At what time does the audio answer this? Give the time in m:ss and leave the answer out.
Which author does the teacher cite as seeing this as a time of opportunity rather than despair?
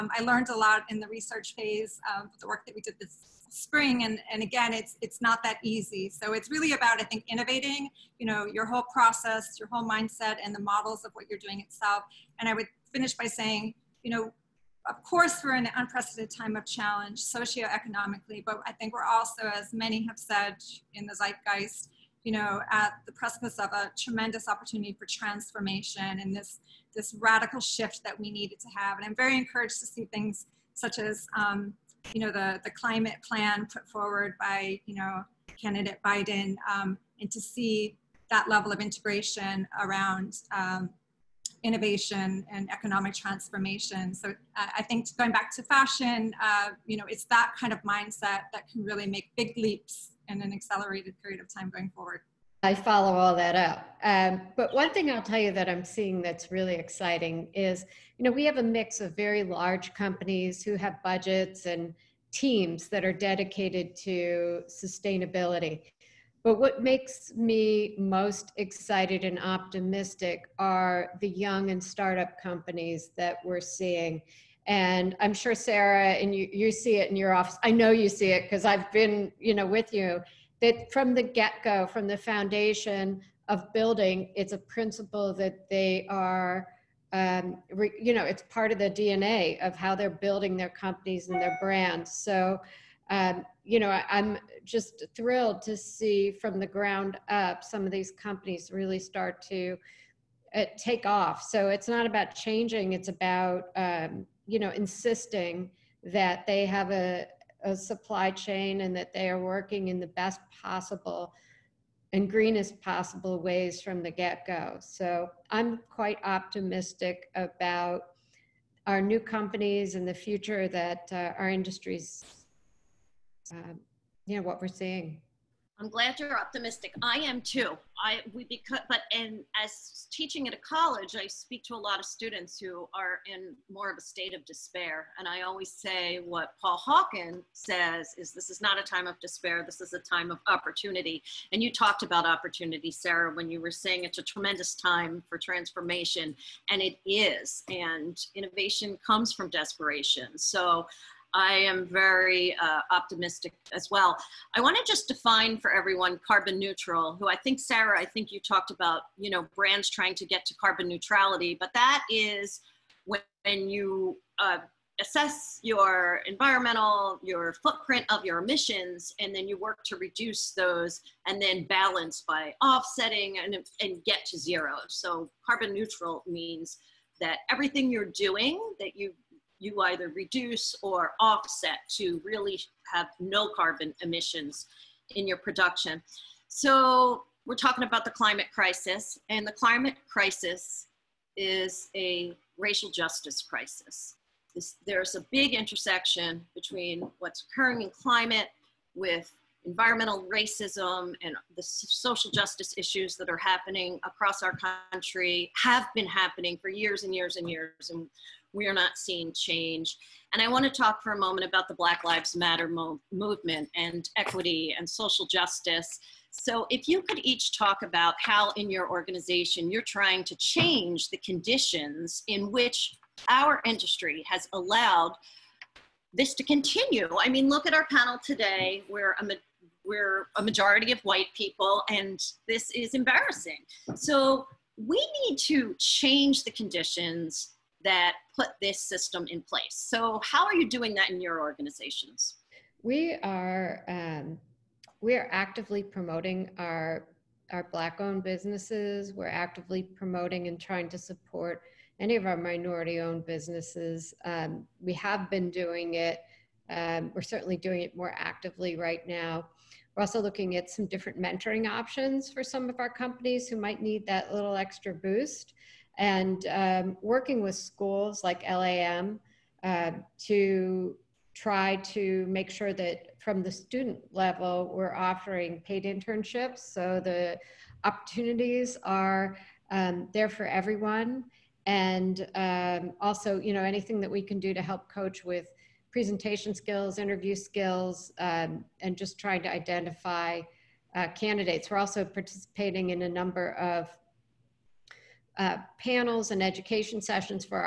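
2:16.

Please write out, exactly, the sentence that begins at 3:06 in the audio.
So we're talking about the climate crisis and the climate crisis is a racial justice crisis.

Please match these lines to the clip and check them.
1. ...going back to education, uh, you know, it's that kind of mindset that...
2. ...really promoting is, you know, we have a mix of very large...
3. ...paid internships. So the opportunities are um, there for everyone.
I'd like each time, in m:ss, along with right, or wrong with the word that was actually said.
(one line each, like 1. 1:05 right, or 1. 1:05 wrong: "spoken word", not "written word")
1. 0:45 wrong: "fashion", not "education"
2. 0:56 wrong: "exciting", not "promoting"
3. 4:35 right.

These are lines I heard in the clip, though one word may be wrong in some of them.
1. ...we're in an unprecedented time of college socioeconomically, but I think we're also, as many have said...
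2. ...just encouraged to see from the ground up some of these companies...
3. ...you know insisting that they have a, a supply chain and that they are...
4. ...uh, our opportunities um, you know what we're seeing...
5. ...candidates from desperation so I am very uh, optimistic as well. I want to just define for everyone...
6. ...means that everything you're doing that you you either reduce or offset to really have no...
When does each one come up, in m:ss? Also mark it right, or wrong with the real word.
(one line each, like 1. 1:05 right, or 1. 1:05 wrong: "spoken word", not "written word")
1. 0:15 wrong: "challenge", not "college"
2. 1:34 wrong: "thrilled", not "encouraged"
3. 1:44 right
4. 2:01 wrong: "industries", not "opportunities"
5. 2:29 wrong: "comes", not "candidates"
6. 2:56 right.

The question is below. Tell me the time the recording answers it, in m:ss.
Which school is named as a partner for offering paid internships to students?
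4:28.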